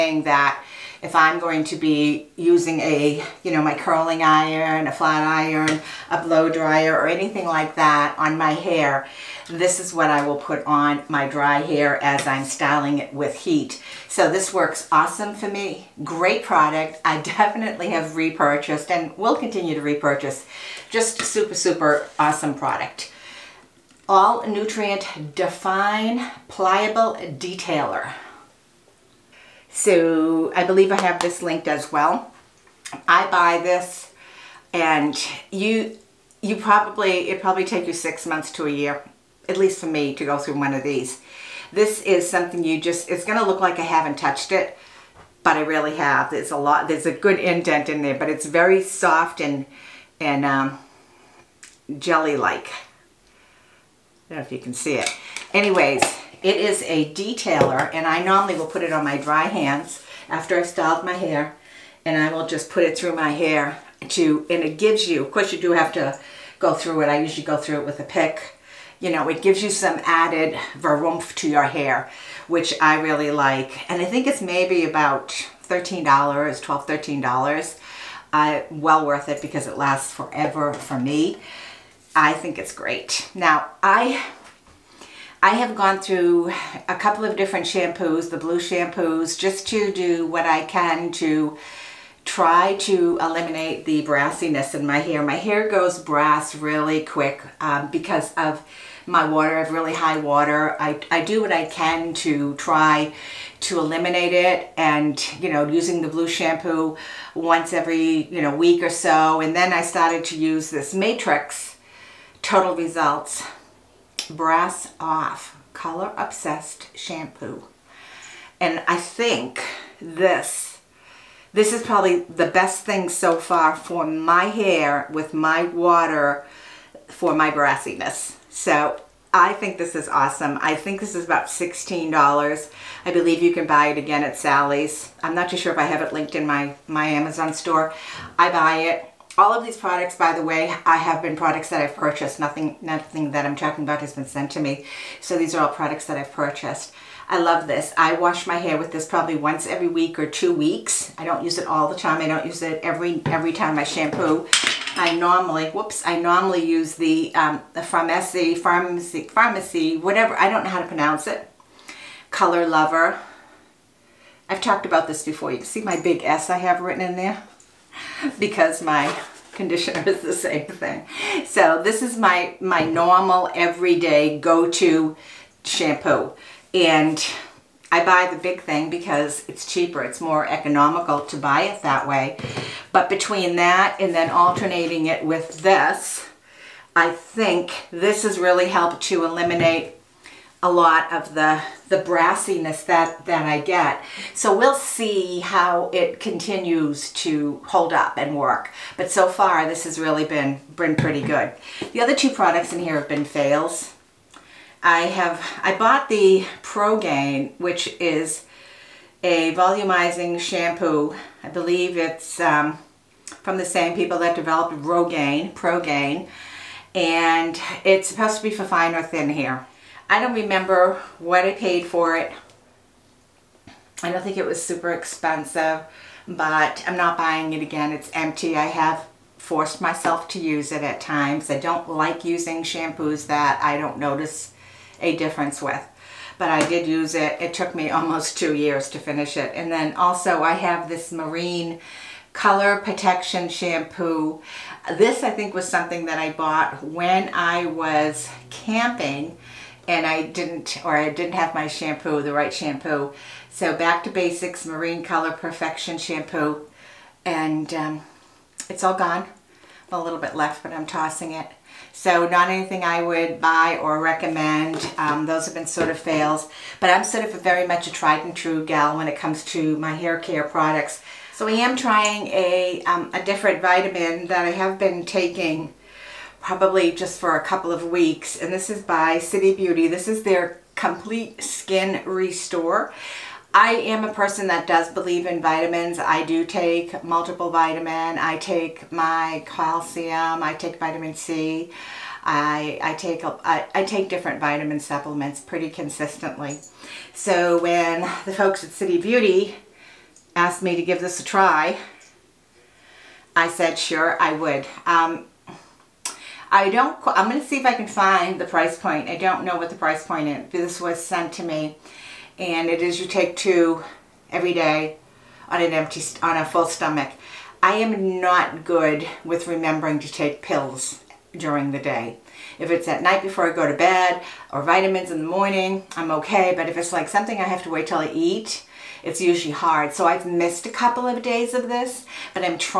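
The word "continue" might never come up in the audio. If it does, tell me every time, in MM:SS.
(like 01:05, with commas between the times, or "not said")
00:19, 03:16.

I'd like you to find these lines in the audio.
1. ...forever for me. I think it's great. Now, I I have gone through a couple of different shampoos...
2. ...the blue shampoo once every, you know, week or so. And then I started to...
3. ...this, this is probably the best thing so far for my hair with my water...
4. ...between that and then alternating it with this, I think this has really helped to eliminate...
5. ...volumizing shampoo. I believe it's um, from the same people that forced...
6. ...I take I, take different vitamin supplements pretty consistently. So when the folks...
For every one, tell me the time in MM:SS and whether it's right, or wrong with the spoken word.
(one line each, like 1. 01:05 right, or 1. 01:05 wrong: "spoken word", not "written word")
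1. 01:20 right
2. 01:46 right
3. 01:59 right
4. 03:03 right
5. 03:29 wrong: "developed", not "forced"
6. 04:52 right.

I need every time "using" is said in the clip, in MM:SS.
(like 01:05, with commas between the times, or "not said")
00:02, 01:45, 03:52.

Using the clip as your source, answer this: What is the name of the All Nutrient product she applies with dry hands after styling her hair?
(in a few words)
Pliable Detailer.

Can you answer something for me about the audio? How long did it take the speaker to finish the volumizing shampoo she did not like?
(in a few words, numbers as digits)
Almost 2 years.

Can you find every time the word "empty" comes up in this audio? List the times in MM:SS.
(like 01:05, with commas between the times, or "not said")
03:48, 05:15.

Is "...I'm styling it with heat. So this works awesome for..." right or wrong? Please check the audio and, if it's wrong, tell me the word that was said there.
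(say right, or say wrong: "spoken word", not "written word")
right.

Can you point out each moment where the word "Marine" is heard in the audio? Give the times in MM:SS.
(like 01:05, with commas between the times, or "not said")
04:01, 04:14.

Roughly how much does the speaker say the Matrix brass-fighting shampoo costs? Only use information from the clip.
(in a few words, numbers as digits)
$16.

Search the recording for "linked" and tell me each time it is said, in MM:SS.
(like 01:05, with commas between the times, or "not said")
00:31, 02:16.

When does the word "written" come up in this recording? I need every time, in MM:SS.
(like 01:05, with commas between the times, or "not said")
02:46.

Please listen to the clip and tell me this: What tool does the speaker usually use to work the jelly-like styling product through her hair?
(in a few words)
A pick.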